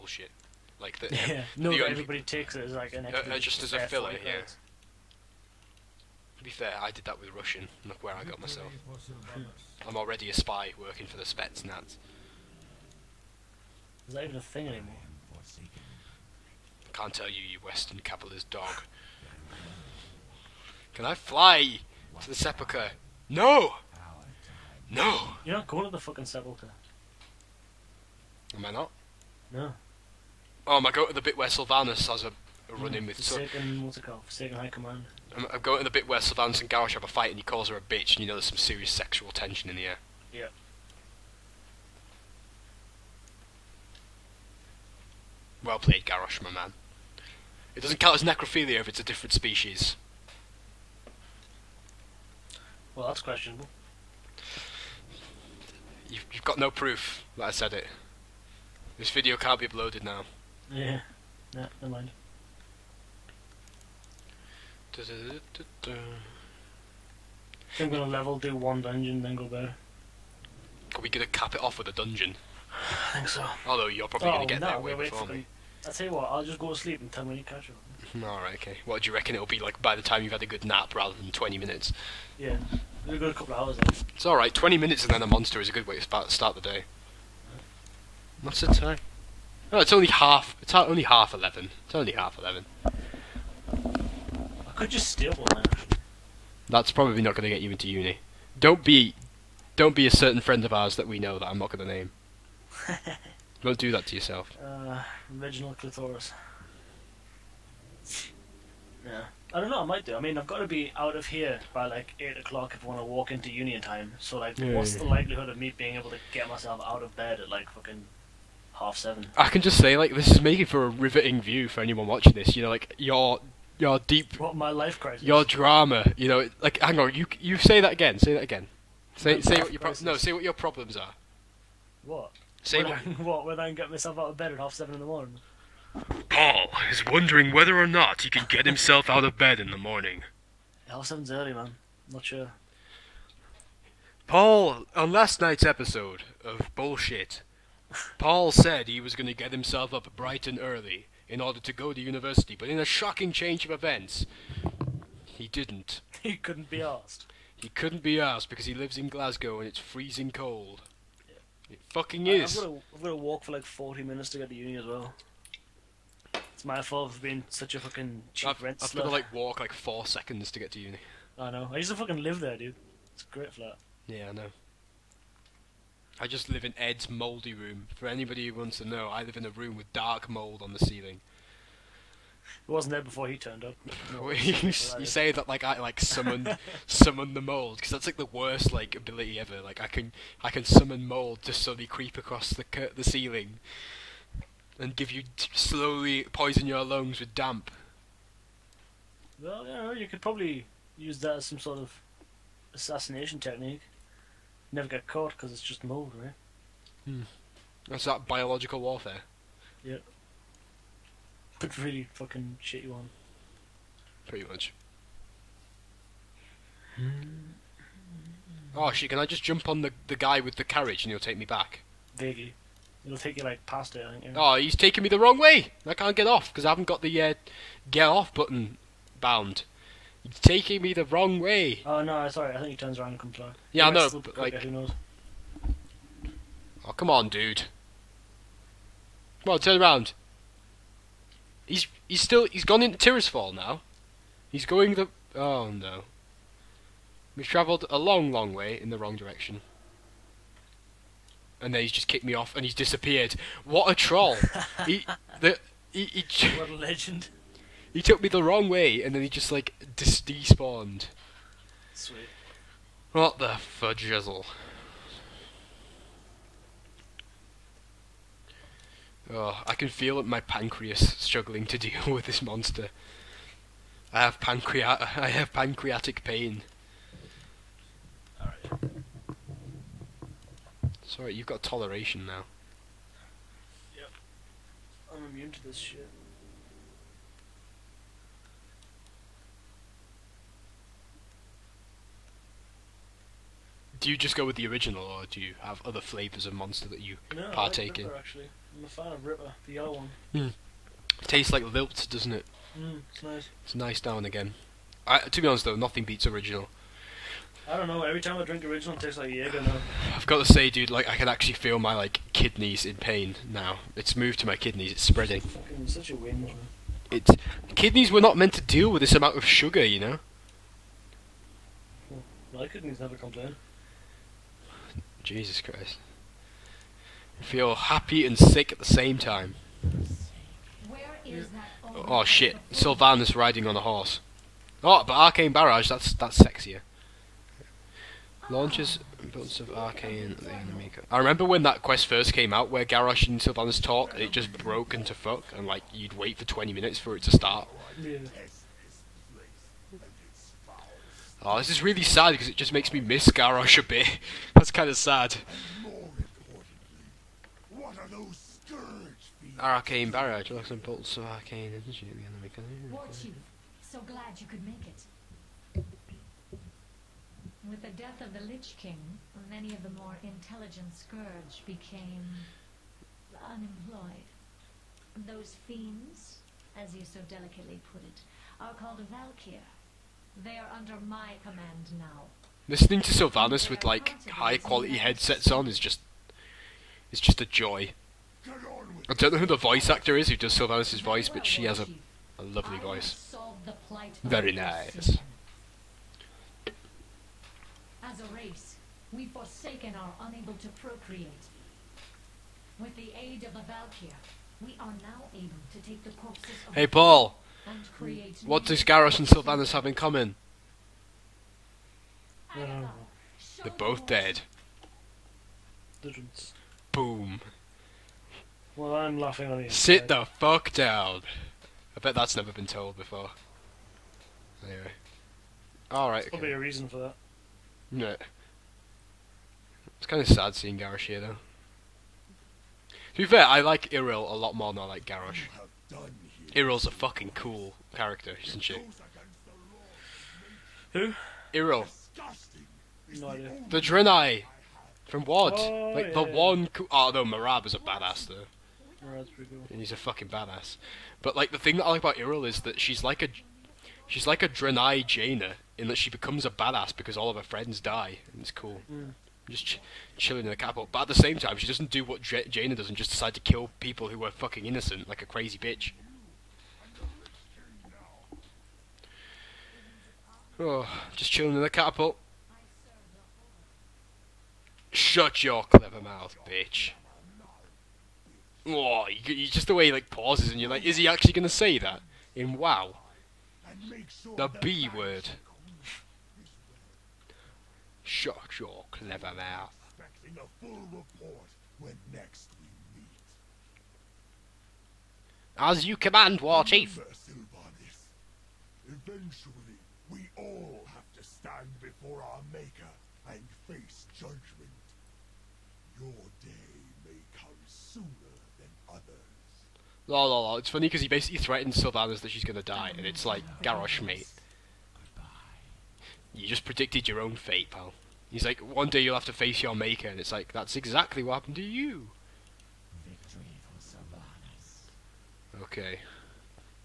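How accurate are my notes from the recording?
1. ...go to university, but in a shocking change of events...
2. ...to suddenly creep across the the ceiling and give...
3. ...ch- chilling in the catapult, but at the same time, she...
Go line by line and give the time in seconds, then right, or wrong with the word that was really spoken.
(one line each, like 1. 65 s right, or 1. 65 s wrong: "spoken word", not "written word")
1. 151 s right
2. 191 s right
3. 459 s right.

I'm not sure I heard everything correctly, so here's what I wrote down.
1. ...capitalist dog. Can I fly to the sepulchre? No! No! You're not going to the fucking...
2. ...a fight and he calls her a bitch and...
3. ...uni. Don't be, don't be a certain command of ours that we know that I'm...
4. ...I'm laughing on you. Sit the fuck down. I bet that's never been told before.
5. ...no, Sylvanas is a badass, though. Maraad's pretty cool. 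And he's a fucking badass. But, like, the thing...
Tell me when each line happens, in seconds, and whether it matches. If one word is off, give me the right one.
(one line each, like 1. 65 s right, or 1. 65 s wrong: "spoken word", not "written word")
1. 17 s right
2. 37 s right
3. 97 s wrong: "friend", not "command"
4. 418 s right
5. 447 s wrong: "Maraad", not "Sylvanas".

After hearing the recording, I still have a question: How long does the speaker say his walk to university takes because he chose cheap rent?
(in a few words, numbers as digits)
40 minutes.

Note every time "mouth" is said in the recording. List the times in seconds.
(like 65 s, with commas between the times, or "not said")
475 s, 489 s.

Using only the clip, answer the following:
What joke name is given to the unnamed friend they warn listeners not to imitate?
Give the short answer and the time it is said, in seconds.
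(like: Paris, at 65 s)
Reginald Clitoris, at 105 s.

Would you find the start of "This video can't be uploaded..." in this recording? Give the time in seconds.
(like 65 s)
58 s.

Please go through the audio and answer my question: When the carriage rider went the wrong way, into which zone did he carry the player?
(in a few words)
Tirisfall.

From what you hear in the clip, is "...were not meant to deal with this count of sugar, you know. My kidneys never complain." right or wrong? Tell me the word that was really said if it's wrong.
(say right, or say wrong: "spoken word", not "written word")
wrong: "amount", not "count".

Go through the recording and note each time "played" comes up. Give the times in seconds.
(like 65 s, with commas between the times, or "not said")
45 s.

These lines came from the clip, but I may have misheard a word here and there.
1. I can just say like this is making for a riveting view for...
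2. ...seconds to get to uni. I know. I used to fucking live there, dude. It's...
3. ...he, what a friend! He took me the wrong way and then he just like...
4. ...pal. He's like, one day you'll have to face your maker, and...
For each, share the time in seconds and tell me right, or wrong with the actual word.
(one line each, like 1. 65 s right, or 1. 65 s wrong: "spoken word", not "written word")
1. 119 s right
2. 170 s right
3. 256 s wrong: "legend", not "friend"
4. 517 s right.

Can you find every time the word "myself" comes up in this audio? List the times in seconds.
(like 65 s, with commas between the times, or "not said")
8 s, 116 s, 133 s.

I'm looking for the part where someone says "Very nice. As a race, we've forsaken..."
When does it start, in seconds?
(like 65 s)
394 s.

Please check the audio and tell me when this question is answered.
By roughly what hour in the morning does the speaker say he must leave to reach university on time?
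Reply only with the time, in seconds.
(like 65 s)
112 s.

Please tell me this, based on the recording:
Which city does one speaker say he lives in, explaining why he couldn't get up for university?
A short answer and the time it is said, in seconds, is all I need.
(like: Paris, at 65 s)
Glasgow, at 159 s.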